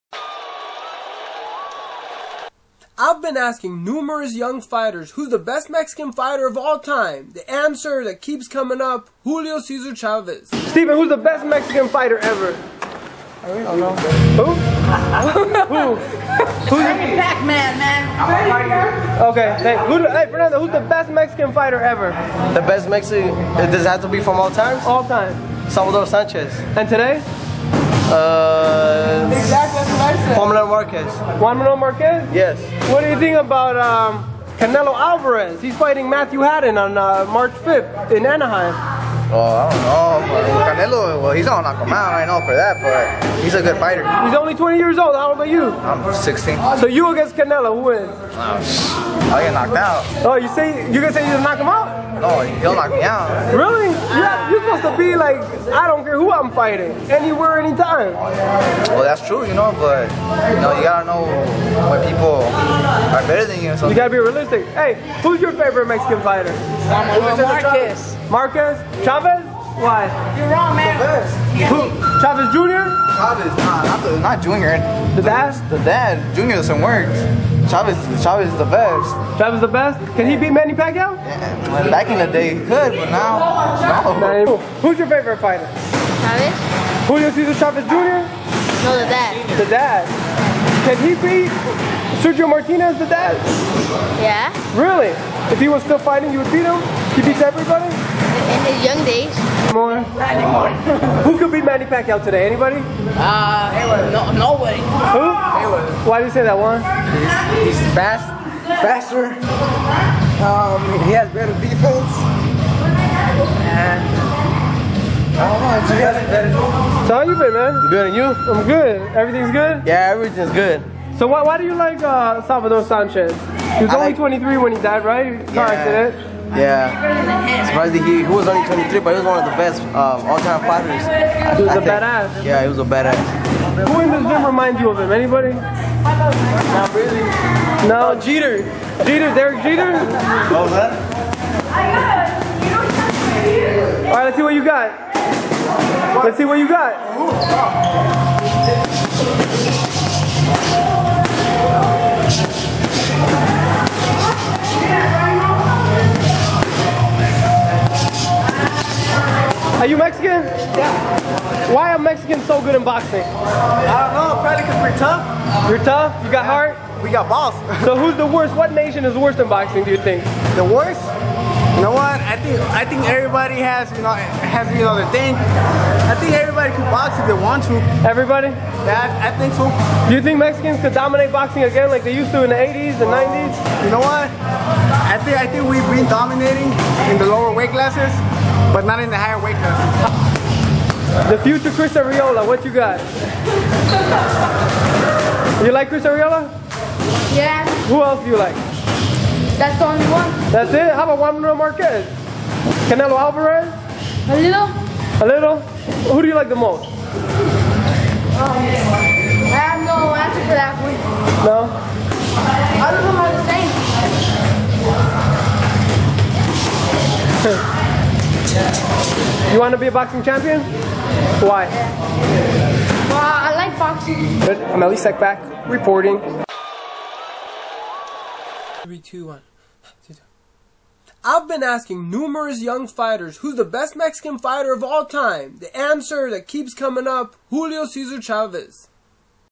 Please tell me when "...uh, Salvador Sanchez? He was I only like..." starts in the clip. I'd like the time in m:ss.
2:02.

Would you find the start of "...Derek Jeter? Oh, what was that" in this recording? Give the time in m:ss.
2:19.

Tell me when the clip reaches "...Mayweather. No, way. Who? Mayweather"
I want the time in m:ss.
1:43.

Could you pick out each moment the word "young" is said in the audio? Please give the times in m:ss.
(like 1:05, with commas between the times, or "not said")
0:04, 3:52.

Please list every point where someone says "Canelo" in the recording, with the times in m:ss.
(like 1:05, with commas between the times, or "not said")
0:34, 0:40, 0:47, 3:22.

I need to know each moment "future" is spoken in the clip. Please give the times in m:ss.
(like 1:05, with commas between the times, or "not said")
3:11.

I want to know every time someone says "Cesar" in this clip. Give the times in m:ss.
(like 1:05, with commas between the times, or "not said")
0:09, 1:27, 3:57.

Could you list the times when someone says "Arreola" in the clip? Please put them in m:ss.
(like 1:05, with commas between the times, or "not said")
3:11, 3:16.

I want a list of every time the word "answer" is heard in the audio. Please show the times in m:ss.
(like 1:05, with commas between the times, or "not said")
0:07, 3:30, 3:55.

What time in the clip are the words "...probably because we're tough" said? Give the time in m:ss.
2:44.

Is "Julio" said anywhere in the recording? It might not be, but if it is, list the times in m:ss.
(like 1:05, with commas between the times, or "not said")
0:09, 1:27, 3:57.